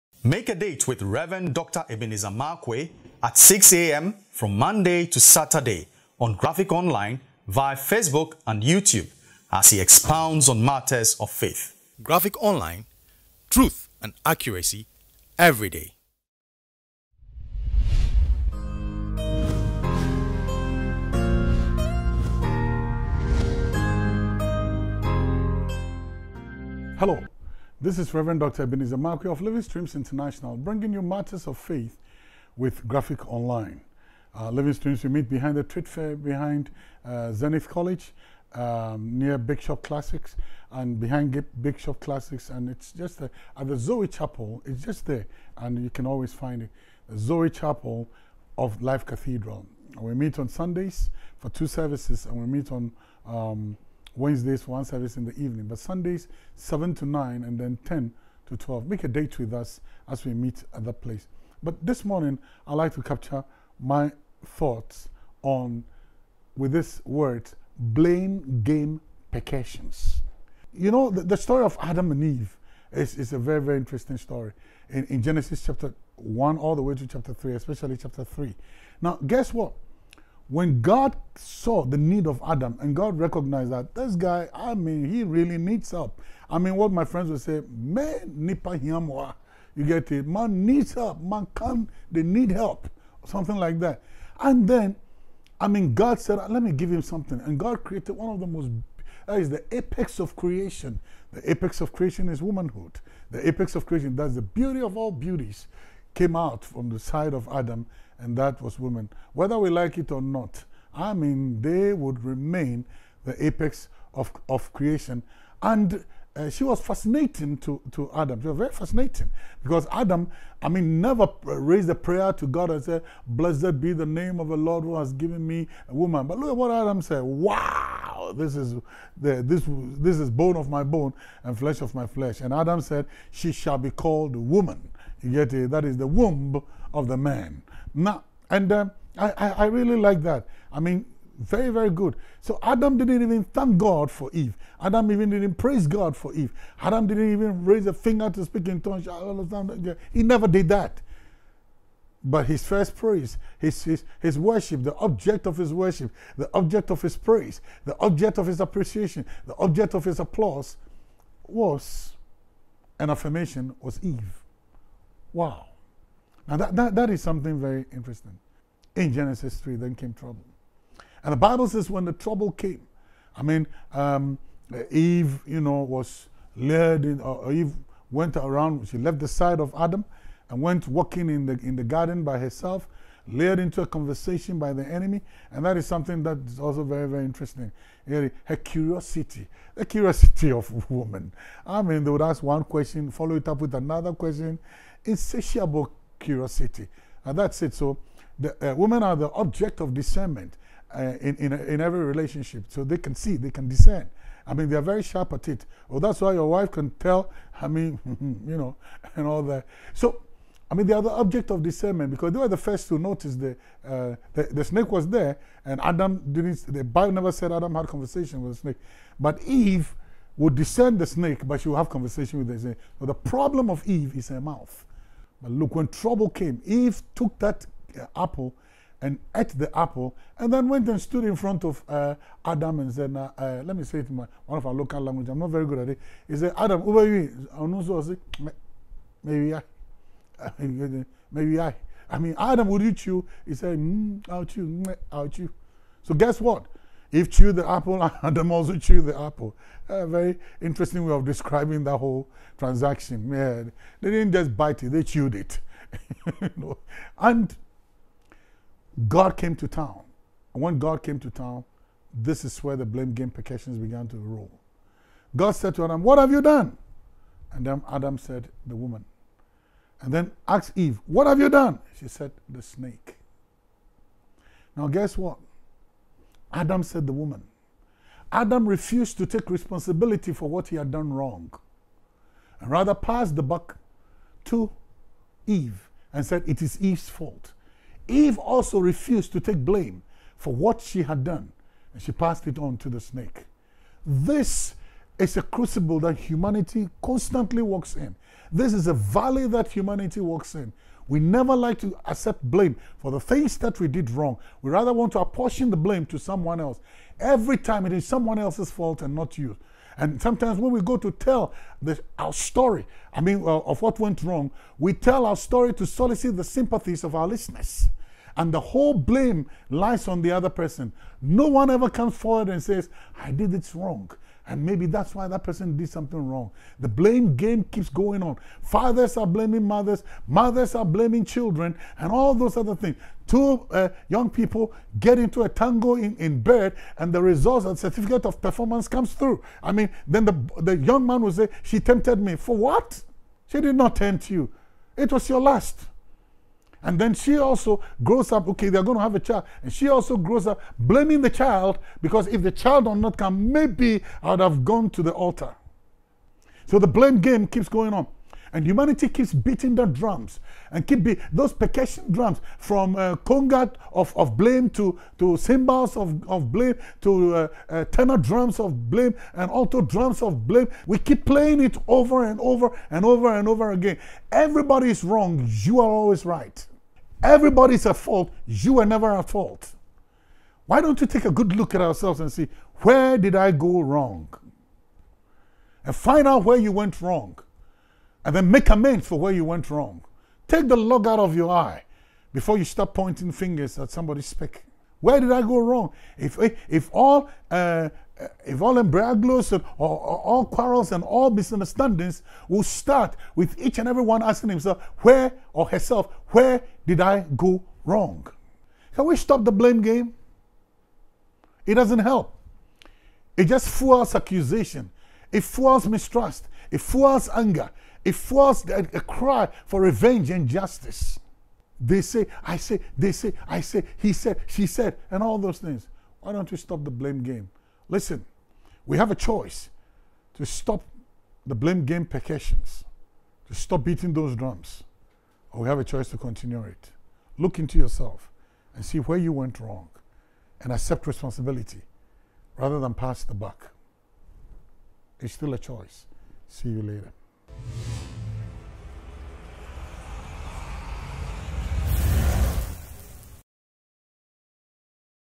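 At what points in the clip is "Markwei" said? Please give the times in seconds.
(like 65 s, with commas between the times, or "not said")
2 s, 28 s.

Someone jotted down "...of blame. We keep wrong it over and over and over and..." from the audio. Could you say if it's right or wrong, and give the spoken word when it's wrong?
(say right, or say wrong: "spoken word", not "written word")
wrong: "playing", not "wrong".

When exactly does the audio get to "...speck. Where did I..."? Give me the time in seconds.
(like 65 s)
394 s.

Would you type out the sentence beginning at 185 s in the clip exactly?
And that is something that is also very, very interesting.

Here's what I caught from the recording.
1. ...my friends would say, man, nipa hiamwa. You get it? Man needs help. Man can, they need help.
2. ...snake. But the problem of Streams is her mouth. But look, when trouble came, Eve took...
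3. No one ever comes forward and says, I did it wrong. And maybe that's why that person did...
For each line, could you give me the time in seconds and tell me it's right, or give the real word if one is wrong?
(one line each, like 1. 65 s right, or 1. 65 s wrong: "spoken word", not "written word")
1. 86 s right
2. 222 s wrong: "Eve", not "Streams"
3. 321 s right.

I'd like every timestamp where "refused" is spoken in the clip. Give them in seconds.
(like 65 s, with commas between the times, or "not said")
278 s, 288 s.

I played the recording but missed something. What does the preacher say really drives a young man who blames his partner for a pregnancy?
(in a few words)
Lust.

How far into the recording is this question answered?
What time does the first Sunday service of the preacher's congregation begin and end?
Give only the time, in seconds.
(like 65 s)
56 s.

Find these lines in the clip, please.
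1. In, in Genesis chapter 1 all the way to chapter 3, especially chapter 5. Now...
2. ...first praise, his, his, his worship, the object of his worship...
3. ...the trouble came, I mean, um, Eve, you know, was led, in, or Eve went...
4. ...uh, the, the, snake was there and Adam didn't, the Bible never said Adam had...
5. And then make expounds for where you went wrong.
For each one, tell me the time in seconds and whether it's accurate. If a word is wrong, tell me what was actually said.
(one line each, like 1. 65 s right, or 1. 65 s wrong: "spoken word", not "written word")
1. 74 s wrong: "3", not "5"
2. 152 s right
3. 172 s right
4. 213 s right
5. 388 s wrong: "amends", not "expounds".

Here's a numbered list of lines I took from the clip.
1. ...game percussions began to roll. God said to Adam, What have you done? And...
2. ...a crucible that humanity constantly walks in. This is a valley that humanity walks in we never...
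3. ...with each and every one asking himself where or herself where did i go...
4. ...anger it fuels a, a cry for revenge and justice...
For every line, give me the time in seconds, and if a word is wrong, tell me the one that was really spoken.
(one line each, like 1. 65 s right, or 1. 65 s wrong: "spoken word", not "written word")
1. 263 s right
2. 295 s right
3. 403 s right
4. 417 s right.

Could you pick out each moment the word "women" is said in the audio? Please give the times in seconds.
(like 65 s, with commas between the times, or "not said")
108 s, 198 s.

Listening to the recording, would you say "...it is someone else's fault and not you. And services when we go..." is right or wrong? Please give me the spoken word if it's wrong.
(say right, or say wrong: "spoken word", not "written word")
wrong: "sometimes", not "services".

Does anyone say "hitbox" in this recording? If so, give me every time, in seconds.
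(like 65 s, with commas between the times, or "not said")
not said.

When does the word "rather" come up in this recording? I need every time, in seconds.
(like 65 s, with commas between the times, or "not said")
282 s, 304 s, 442 s.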